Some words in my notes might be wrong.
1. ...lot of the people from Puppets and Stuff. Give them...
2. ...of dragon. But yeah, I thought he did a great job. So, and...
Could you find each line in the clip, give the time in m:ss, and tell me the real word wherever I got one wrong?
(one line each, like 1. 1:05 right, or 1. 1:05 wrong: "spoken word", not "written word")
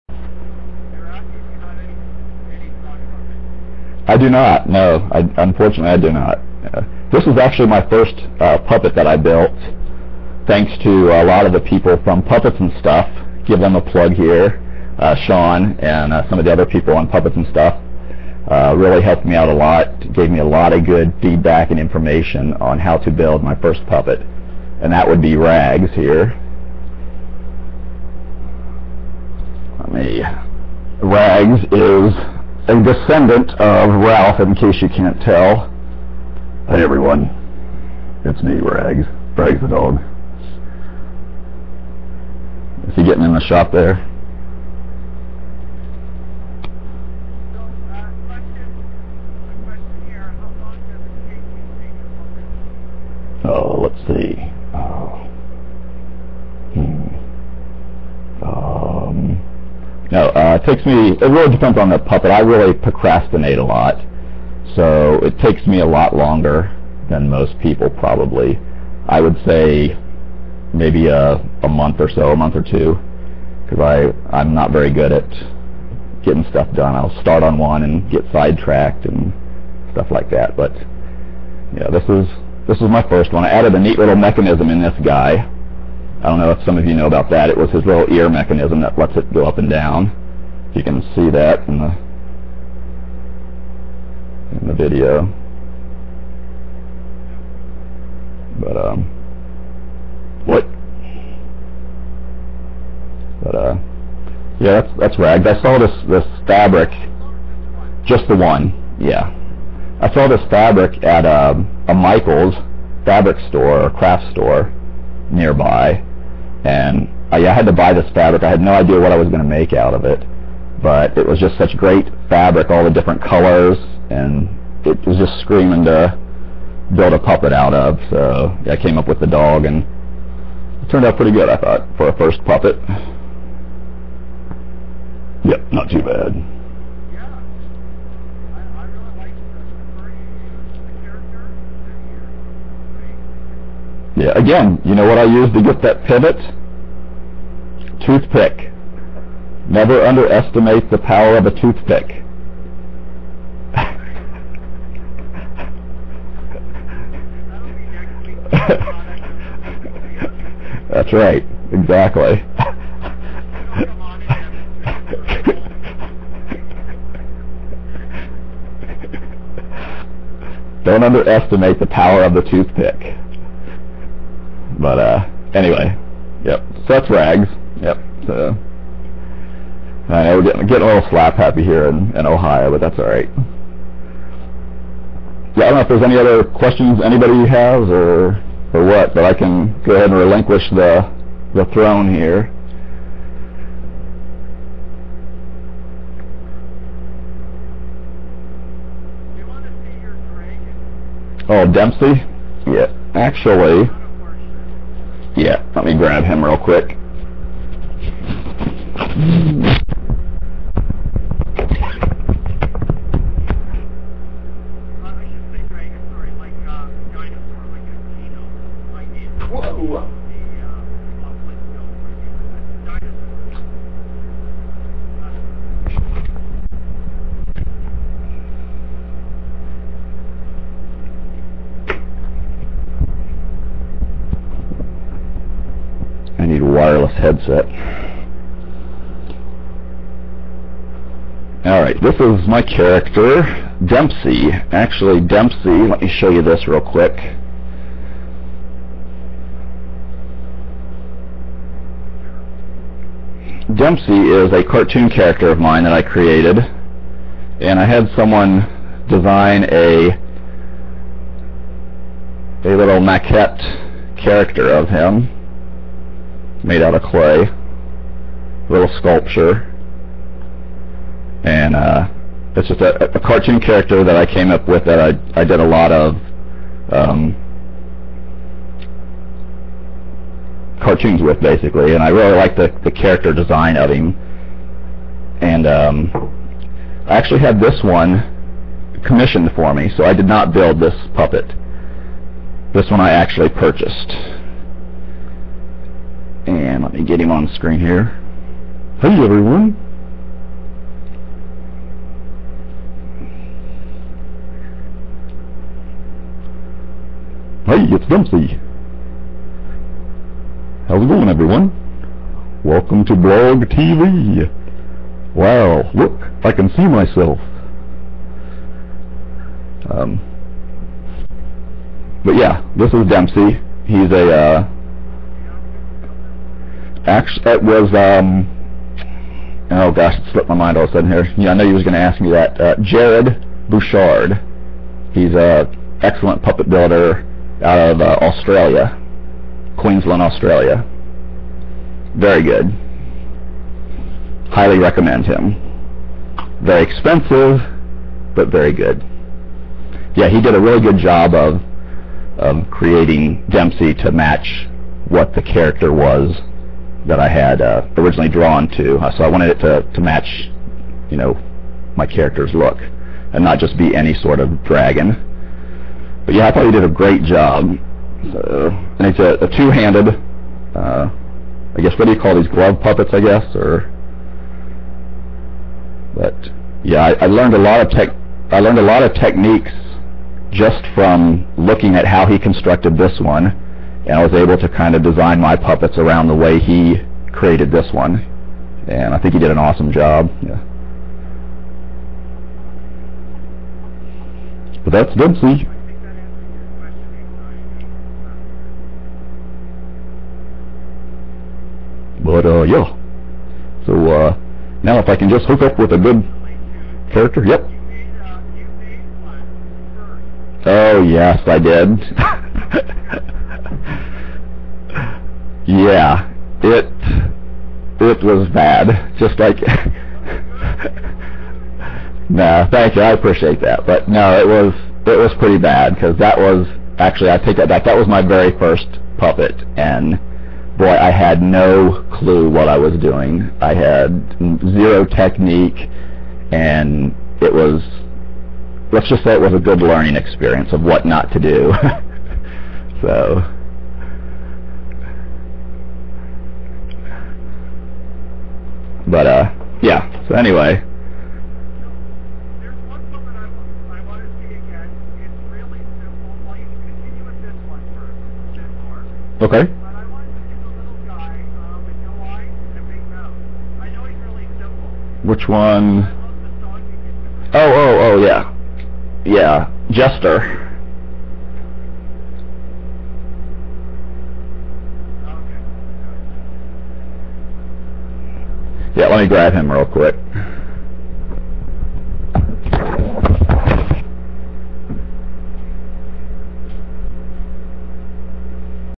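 1. 0:11 right
2. 6:04 right.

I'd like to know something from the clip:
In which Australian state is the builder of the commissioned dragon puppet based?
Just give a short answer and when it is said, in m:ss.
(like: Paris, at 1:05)
Queensland, at 5:39.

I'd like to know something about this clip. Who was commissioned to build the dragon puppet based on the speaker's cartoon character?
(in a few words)
Jared Bouchard.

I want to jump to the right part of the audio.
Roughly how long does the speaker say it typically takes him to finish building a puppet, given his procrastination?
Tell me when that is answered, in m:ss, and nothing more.
1:12.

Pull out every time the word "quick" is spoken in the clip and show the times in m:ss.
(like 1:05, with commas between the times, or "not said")
3:26, 4:06, 7:59.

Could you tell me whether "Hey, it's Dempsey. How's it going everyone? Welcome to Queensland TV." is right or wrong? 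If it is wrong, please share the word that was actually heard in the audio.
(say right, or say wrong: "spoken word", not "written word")
wrong: "Blog", not "Queensland".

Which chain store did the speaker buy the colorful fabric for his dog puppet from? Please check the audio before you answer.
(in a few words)
Michael's.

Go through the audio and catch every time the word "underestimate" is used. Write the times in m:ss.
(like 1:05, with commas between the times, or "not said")
2:30, 2:51.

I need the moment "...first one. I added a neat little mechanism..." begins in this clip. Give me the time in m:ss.
1:23.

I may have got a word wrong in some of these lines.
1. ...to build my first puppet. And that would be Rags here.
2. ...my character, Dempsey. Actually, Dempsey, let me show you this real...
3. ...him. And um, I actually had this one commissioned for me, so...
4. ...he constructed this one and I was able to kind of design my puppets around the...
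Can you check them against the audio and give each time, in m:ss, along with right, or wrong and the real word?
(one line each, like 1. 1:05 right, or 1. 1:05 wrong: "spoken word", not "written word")
1. 0:22 right
2. 4:02 right
3. 4:43 right
4. 6:22 right.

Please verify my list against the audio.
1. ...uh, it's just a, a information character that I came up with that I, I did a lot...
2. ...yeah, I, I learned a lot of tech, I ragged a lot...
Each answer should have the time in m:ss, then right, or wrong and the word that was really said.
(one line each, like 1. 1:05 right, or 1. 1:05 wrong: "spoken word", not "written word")
1. 4:31 wrong: "cartoon", not "information"
2. 6:16 wrong: "learned", not "ragged".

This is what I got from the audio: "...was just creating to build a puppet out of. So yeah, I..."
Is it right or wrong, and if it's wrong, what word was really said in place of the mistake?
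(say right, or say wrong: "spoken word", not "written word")
wrong: "screaming", not "creating".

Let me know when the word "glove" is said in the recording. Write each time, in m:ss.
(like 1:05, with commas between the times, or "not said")
6:12.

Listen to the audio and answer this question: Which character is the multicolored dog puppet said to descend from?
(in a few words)
Ralph.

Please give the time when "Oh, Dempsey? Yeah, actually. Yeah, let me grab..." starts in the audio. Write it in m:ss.
3:21.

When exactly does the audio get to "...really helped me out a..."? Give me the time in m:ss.
0:18.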